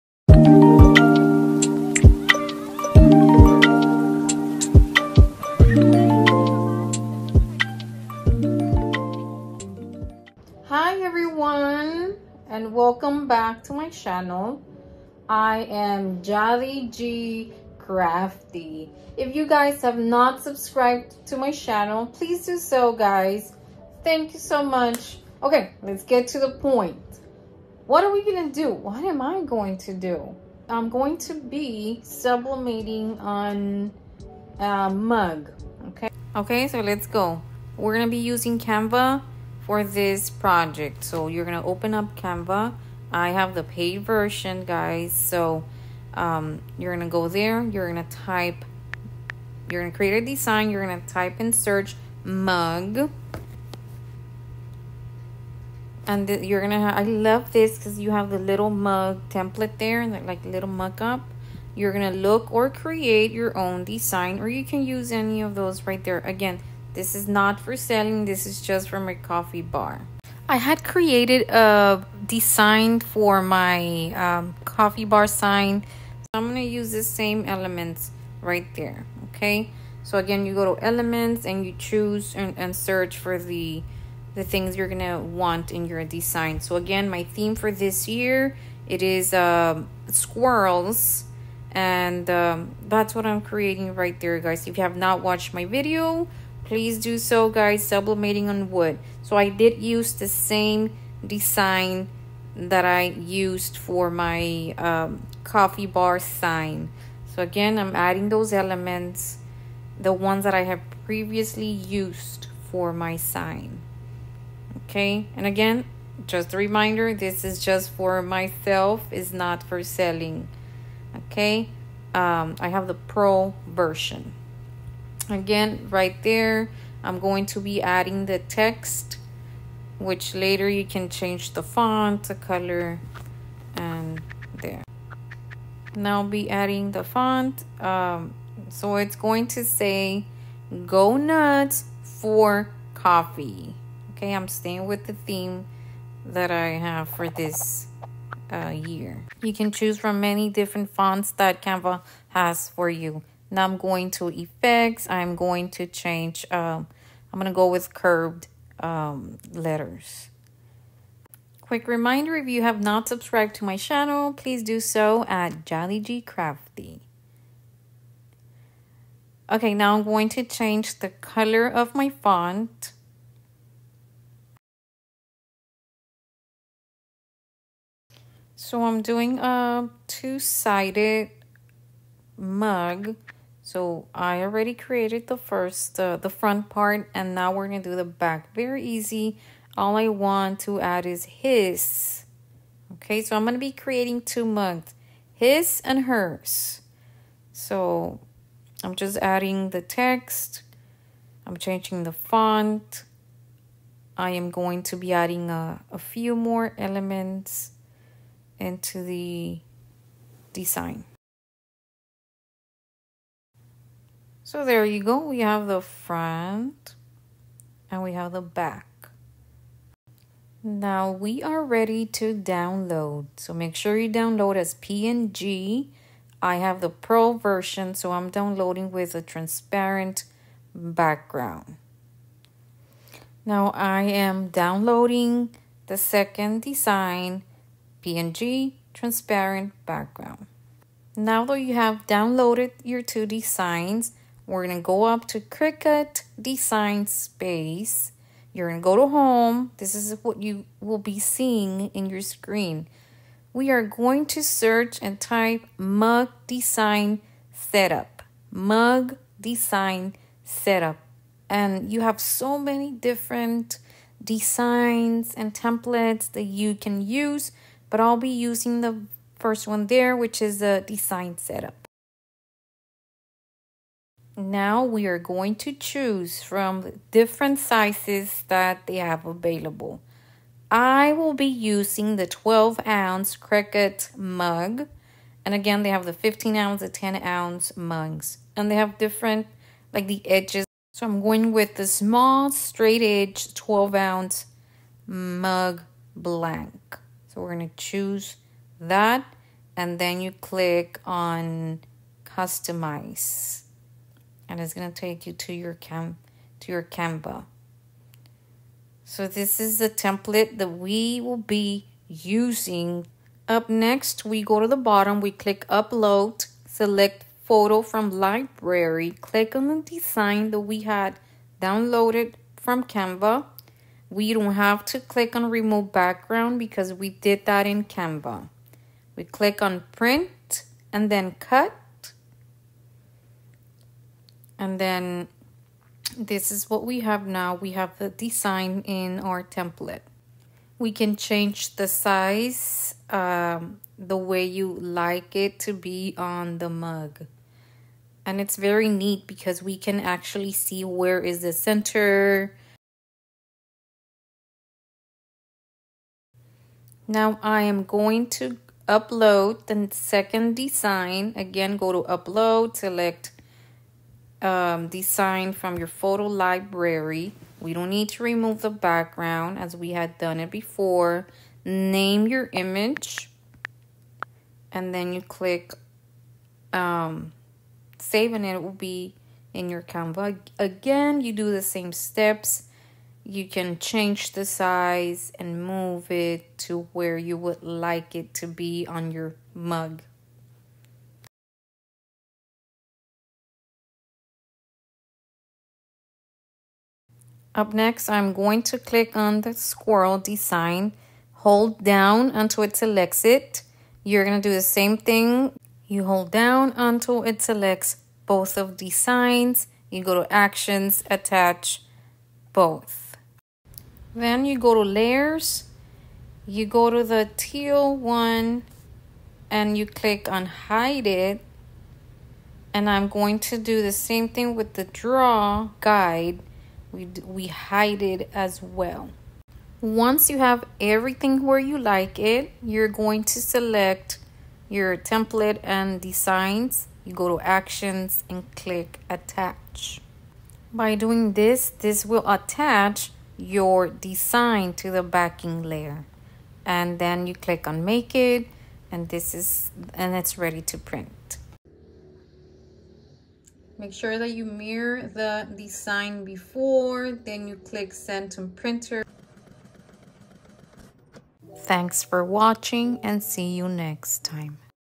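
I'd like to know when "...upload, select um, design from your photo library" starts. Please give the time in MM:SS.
06:02.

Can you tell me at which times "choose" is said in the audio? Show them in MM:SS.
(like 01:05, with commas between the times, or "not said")
01:21, 02:29, 04:35, 04:57.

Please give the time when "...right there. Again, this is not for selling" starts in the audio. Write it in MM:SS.
01:05.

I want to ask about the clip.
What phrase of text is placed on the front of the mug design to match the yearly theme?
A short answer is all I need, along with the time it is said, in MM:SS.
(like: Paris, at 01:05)
Go nuts for coffee, at 02:20.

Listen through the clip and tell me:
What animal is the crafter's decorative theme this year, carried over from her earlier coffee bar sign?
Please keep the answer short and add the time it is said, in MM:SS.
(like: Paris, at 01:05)
Squirrels, at 01:30.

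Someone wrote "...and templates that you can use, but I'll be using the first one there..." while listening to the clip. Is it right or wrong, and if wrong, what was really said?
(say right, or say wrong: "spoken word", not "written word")
right.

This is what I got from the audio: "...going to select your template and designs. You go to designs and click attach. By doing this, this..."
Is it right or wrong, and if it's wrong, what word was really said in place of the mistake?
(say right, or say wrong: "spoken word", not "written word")
wrong: "actions", not "designs".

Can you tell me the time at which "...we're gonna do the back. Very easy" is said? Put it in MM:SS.
03:07.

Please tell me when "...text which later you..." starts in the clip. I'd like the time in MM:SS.
02:08.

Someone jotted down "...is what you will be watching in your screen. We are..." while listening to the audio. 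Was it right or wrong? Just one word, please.
wrong.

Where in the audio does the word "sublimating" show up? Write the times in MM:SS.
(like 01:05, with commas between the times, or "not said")
00:32, 01:37.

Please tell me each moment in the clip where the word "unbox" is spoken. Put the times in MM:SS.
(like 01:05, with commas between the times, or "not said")
not said.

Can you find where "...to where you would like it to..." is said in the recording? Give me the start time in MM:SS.
06:26.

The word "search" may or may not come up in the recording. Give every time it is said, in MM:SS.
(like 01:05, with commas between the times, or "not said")
00:51, 01:22, 04:14.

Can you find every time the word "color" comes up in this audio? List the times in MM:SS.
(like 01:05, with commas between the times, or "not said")
02:12, 02:51.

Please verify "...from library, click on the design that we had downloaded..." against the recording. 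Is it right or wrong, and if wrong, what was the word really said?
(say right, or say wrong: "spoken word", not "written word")
right.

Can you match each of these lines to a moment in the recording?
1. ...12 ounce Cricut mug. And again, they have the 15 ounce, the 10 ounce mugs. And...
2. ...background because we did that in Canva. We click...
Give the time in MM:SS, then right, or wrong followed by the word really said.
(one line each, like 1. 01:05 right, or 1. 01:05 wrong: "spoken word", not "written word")
1. 04:42 right
2. 05:25 right.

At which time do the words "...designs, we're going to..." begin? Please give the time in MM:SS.
04:03.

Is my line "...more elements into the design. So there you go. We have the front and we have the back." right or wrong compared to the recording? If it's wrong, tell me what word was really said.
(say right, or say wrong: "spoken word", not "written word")
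right.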